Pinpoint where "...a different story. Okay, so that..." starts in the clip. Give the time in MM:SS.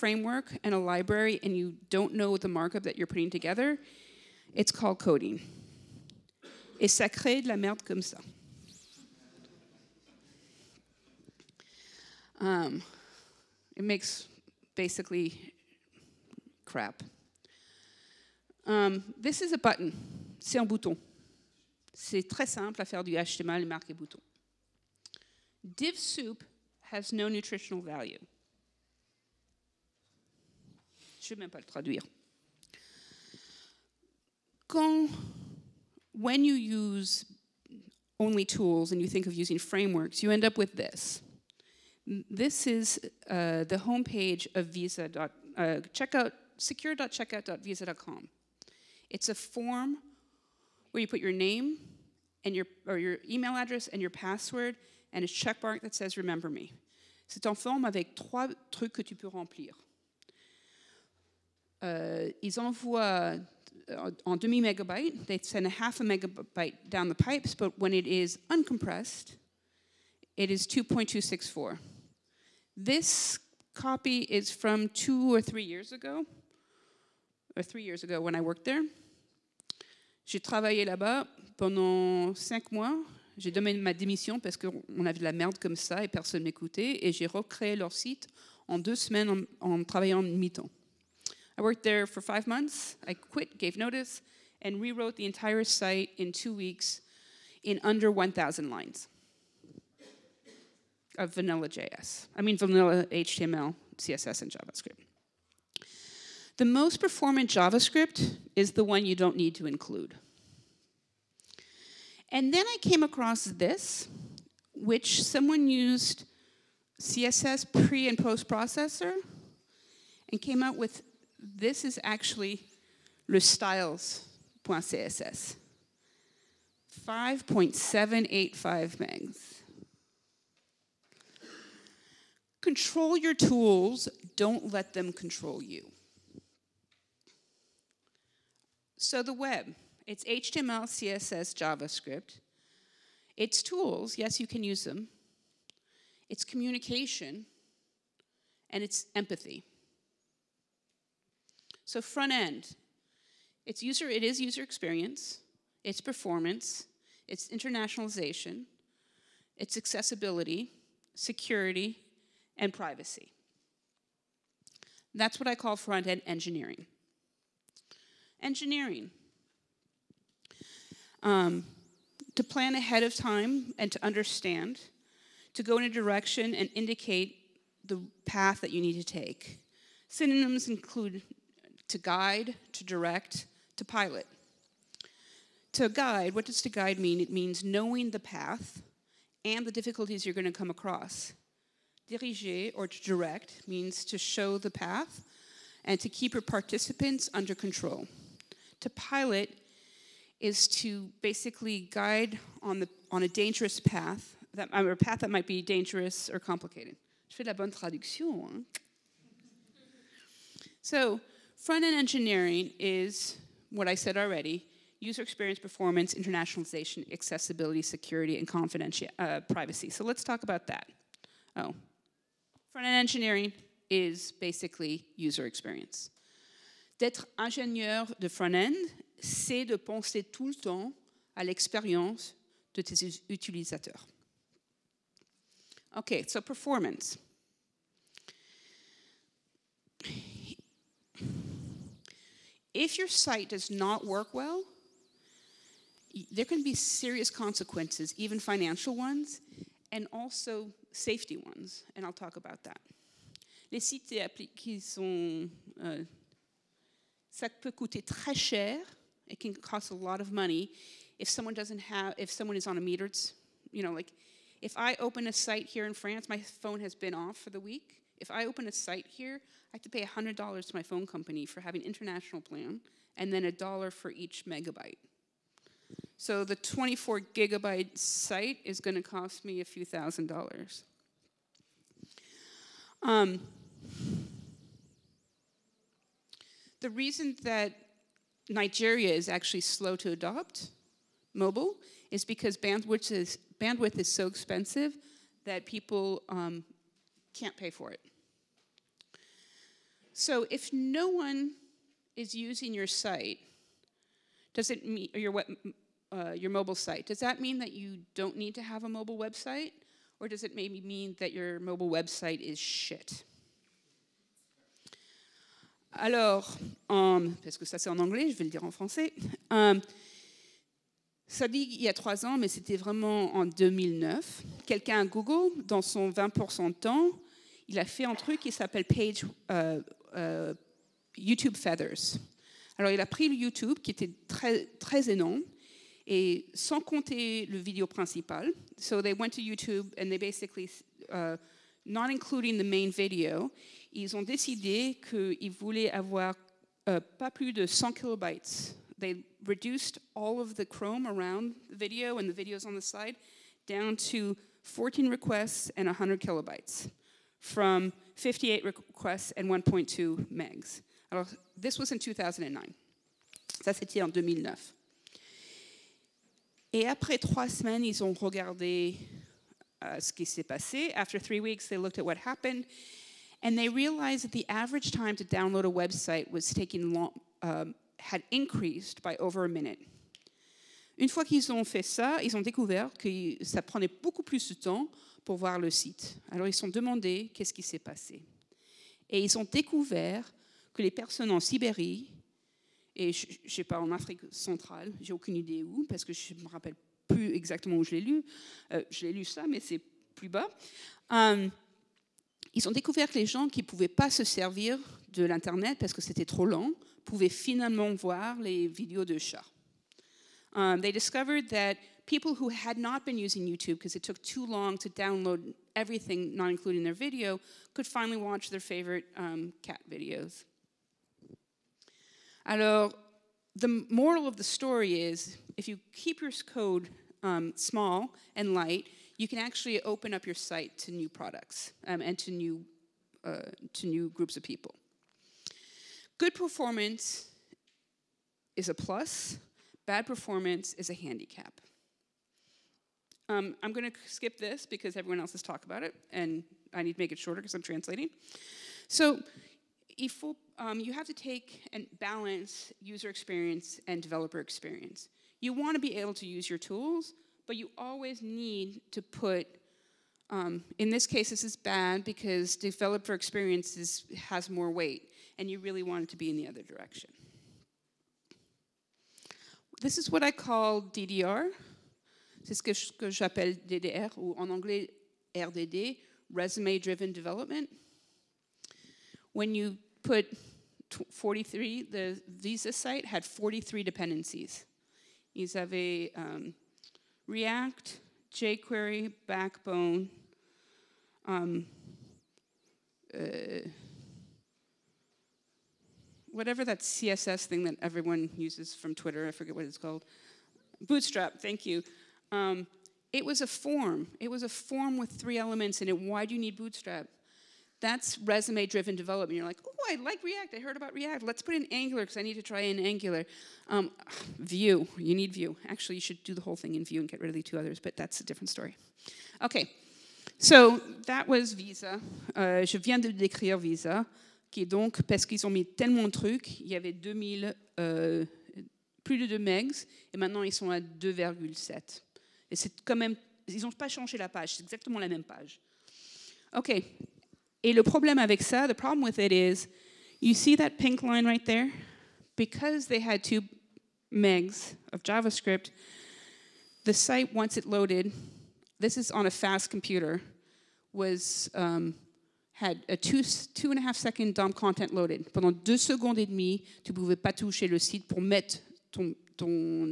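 08:38.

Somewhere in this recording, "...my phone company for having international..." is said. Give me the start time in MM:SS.
04:30.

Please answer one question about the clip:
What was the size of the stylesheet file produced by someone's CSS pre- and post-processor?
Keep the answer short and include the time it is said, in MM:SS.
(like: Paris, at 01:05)
5.785 megs, at 02:07.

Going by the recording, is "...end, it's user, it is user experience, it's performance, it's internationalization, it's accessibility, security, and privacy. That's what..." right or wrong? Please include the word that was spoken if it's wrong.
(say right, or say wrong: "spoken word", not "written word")
right.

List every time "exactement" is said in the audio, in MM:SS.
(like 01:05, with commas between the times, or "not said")
06:37, 08:54.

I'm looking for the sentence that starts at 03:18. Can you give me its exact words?
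To pilot is to basically guide on, the, on a dangerous path, that, or a path that might be dangerous or complicated.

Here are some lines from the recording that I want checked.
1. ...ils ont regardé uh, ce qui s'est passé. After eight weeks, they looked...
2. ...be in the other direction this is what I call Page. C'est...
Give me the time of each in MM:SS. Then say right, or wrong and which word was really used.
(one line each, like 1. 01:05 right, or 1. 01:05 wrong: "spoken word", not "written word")
1. 06:07 wrong: "three", not "eight"
2. 07:46 wrong: "DDR", not "Page".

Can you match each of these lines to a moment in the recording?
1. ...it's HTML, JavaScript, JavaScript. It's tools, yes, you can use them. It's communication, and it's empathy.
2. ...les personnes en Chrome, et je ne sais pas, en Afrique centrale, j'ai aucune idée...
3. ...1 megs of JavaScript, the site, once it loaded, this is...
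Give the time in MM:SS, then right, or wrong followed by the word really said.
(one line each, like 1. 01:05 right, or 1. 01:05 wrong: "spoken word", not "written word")
1. 02:20 wrong: "CSS", not "JavaScript"
2. 06:30 wrong: "Sibérie", not "Chrome"
3. 09:03 wrong: "2", not "1".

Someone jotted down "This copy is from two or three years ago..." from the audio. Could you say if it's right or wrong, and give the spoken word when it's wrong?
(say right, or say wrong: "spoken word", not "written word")
right.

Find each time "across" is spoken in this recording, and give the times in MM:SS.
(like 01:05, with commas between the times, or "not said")
01:53, 03:10.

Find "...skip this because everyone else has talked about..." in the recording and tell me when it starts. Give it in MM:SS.
07:24.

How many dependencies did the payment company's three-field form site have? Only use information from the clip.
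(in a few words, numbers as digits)
43.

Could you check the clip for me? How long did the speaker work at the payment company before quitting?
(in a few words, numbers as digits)
5 months.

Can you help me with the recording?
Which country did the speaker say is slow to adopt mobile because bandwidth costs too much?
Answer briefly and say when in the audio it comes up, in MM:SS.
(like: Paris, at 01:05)
Nigeria, at 04:48.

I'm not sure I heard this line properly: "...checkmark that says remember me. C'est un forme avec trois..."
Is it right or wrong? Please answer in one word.
right.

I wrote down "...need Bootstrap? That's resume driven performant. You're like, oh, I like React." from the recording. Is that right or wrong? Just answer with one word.
wrong.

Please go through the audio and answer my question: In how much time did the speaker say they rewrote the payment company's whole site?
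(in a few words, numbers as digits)
2 weeks.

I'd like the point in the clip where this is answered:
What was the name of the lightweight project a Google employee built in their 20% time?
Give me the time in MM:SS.
05:31.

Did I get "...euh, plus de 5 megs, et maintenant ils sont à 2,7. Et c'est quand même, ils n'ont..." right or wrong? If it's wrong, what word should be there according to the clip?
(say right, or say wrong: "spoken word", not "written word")
wrong: "2", not "5".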